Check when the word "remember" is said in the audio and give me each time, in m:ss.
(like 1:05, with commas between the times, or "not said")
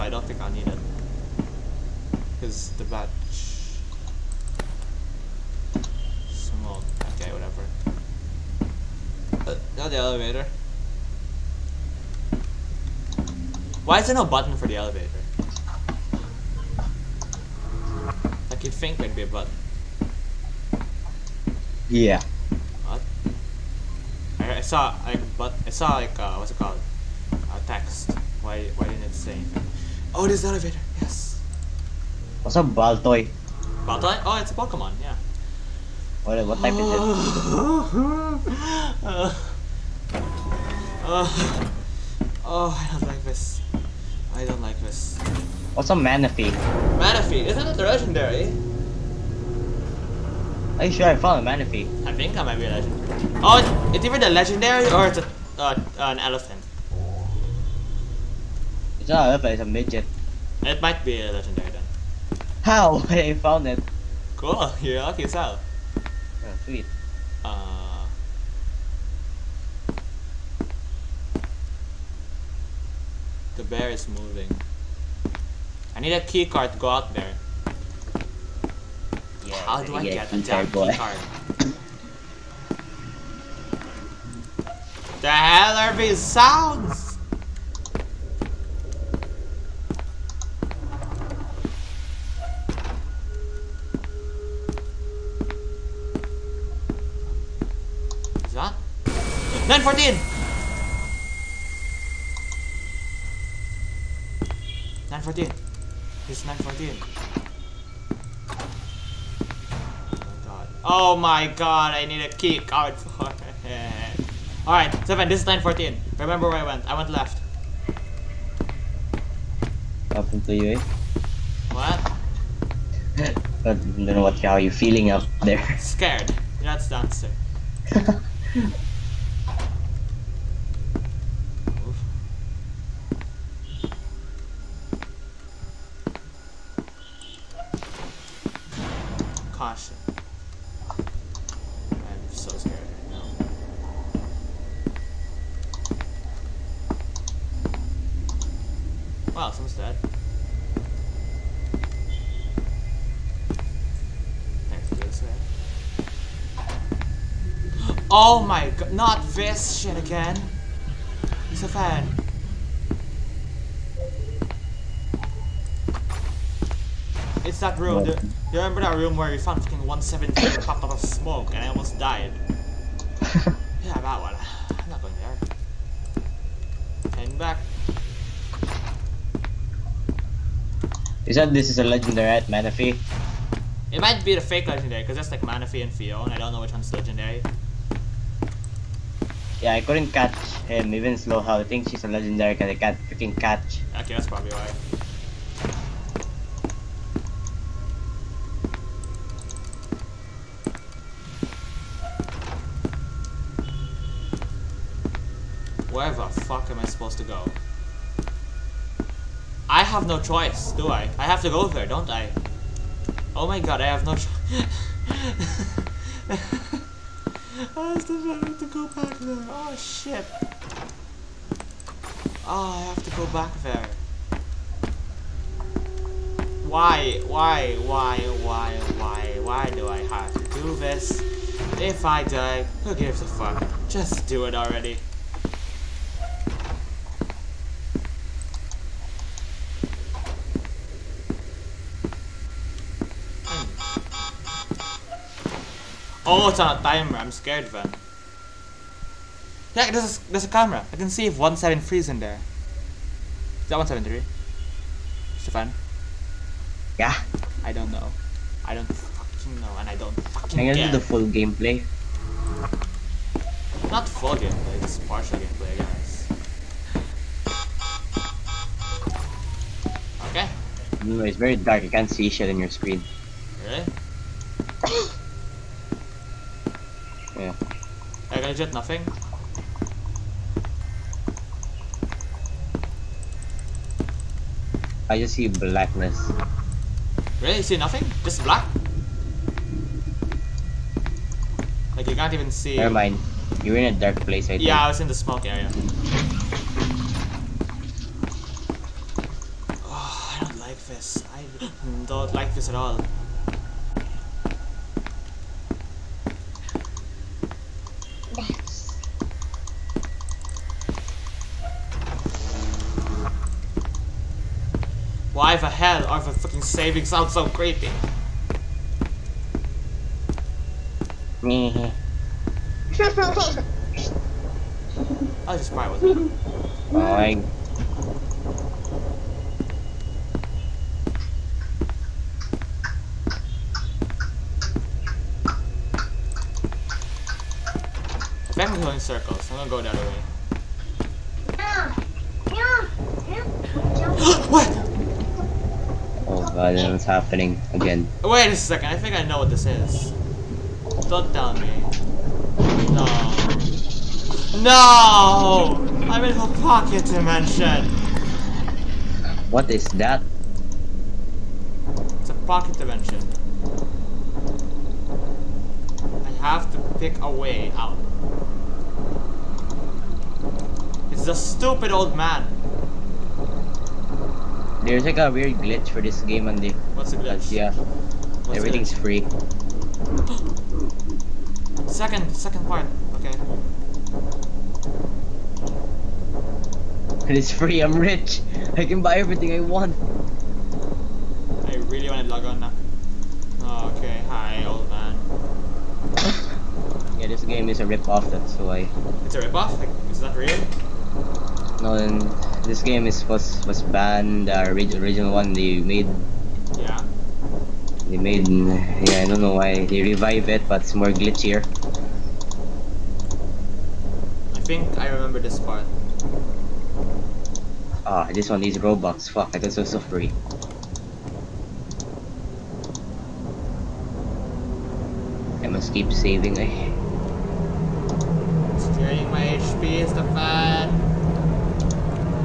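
1:56, 2:48, 6:55.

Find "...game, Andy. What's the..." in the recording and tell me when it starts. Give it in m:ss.
6:16.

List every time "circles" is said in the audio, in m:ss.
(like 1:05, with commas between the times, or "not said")
5:38.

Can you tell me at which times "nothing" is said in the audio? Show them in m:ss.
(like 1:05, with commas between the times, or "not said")
4:38, 4:47.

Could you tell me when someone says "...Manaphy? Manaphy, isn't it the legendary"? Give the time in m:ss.
0:45.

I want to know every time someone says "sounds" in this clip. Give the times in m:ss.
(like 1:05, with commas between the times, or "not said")
1:26, 5:17.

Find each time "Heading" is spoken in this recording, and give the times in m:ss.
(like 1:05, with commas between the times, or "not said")
2:57.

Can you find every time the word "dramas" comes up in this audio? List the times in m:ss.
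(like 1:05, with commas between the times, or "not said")
not said.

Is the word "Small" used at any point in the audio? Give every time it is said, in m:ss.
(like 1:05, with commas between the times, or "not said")
0:06.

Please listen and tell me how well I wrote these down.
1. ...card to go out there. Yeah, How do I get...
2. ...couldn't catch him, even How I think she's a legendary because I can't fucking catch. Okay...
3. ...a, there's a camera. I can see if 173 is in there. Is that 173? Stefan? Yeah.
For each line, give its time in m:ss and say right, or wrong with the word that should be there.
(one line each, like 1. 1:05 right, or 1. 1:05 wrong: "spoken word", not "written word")
1. 1:16 right
2. 3:09 wrong: "freaking", not "fucking"
3. 4:10 right.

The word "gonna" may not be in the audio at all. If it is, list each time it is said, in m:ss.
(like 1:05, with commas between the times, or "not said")
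4:20, 5:39.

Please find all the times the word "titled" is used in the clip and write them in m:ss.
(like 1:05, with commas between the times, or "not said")
not said.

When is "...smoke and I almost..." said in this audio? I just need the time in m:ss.
2:50.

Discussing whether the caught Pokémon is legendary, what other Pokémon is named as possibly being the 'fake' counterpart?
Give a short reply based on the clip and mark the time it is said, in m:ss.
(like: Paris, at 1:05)
Phione, at 3:05.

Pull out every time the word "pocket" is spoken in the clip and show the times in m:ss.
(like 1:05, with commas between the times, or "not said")
5:56, 6:02.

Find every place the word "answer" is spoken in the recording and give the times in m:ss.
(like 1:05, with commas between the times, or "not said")
2:06.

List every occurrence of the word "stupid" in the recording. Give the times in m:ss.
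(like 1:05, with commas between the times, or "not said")
6:11.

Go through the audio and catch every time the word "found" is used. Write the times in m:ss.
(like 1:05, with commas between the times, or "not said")
0:51, 1:03, 2:49.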